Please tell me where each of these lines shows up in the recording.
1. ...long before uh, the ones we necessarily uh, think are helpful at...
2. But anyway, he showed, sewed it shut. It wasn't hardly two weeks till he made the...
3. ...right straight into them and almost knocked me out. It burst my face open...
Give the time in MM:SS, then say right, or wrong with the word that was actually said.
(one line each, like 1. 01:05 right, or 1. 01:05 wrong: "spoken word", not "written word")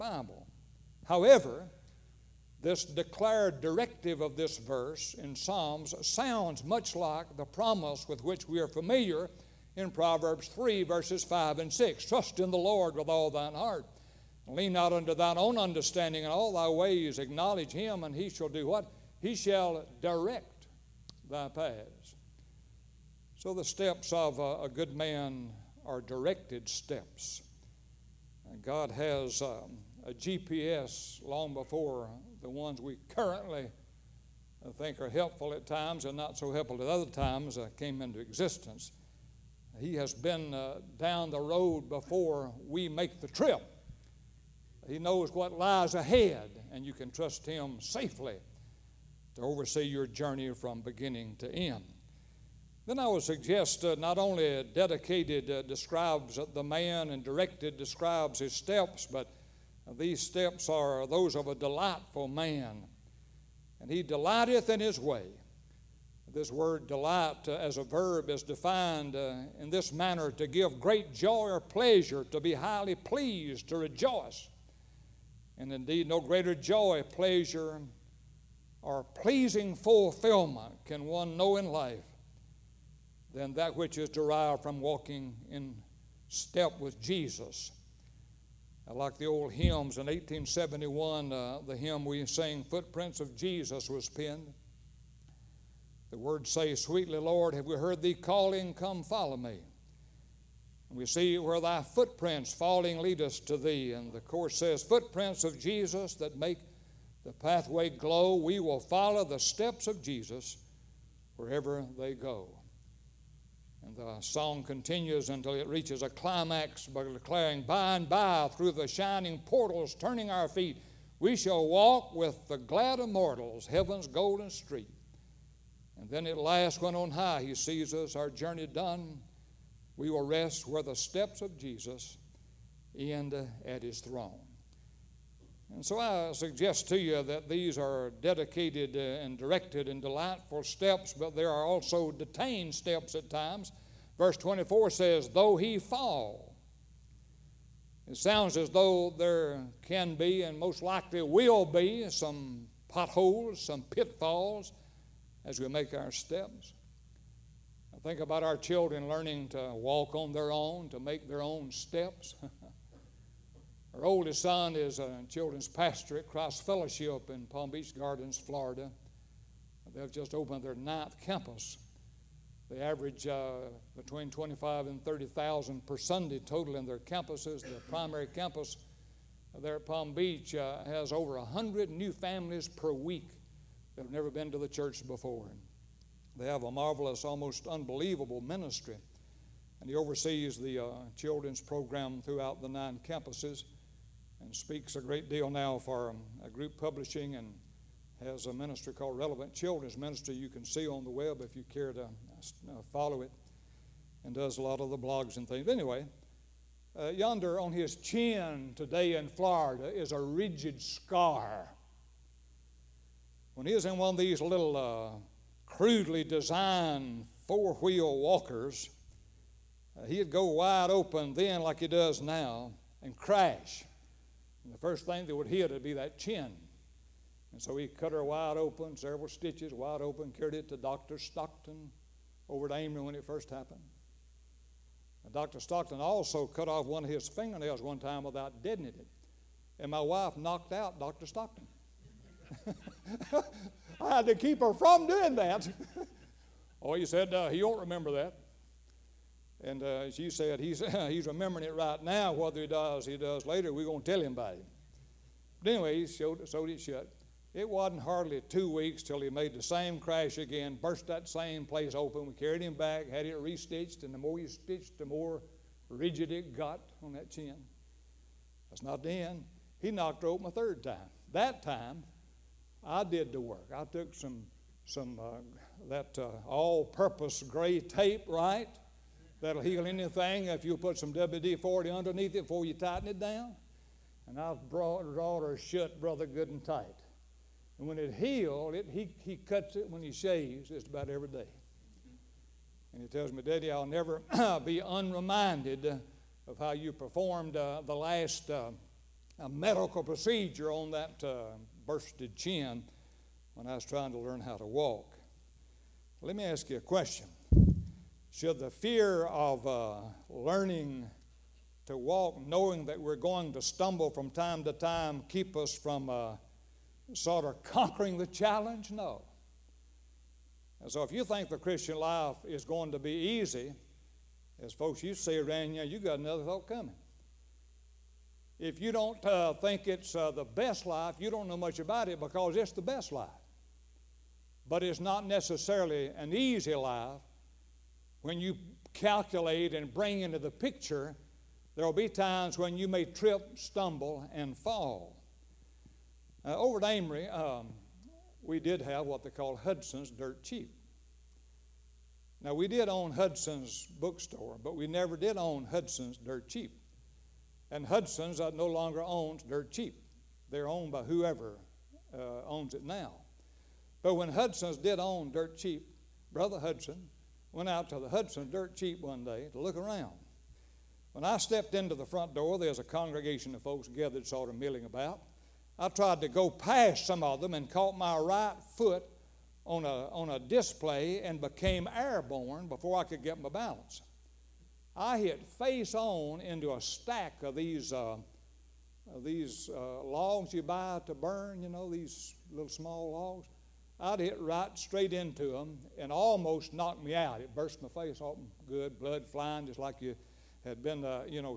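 1. 00:31 wrong: "currently", not "necessarily"
2. 04:15 right
3. 06:34 right.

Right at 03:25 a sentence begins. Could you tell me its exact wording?
Anyway, uh, yonder on his chin today in Florida is a rigid scar.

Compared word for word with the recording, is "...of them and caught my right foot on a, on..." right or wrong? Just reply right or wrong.
right.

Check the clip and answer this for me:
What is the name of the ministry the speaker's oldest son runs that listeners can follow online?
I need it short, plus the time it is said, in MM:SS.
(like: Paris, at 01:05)
Relevant Children's Ministry, at 03:19.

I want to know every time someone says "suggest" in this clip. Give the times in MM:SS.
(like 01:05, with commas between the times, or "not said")
00:53, 02:16.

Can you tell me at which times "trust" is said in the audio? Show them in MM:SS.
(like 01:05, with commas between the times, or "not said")
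00:12, 00:47.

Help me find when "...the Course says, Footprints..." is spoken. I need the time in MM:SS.
01:44.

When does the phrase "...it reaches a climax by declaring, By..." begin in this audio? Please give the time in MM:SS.
01:55.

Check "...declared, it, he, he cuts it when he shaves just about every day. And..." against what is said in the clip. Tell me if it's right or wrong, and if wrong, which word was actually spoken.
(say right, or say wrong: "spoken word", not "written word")
wrong: "healed", not "declared".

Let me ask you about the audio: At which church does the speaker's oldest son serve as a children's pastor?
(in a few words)
Christ Fellowship.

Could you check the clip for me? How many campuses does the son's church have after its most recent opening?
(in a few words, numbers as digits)
9.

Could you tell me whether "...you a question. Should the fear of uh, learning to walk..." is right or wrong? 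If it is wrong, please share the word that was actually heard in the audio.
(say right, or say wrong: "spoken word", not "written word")
right.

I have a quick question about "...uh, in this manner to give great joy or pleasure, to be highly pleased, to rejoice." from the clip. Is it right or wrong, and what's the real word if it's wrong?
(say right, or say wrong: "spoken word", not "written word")
right.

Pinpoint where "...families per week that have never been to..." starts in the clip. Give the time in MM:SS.
03:02.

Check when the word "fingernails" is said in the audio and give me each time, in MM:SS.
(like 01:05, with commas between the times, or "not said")
03:57.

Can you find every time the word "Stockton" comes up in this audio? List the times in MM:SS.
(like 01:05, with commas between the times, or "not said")
03:51, 03:55, 04:01.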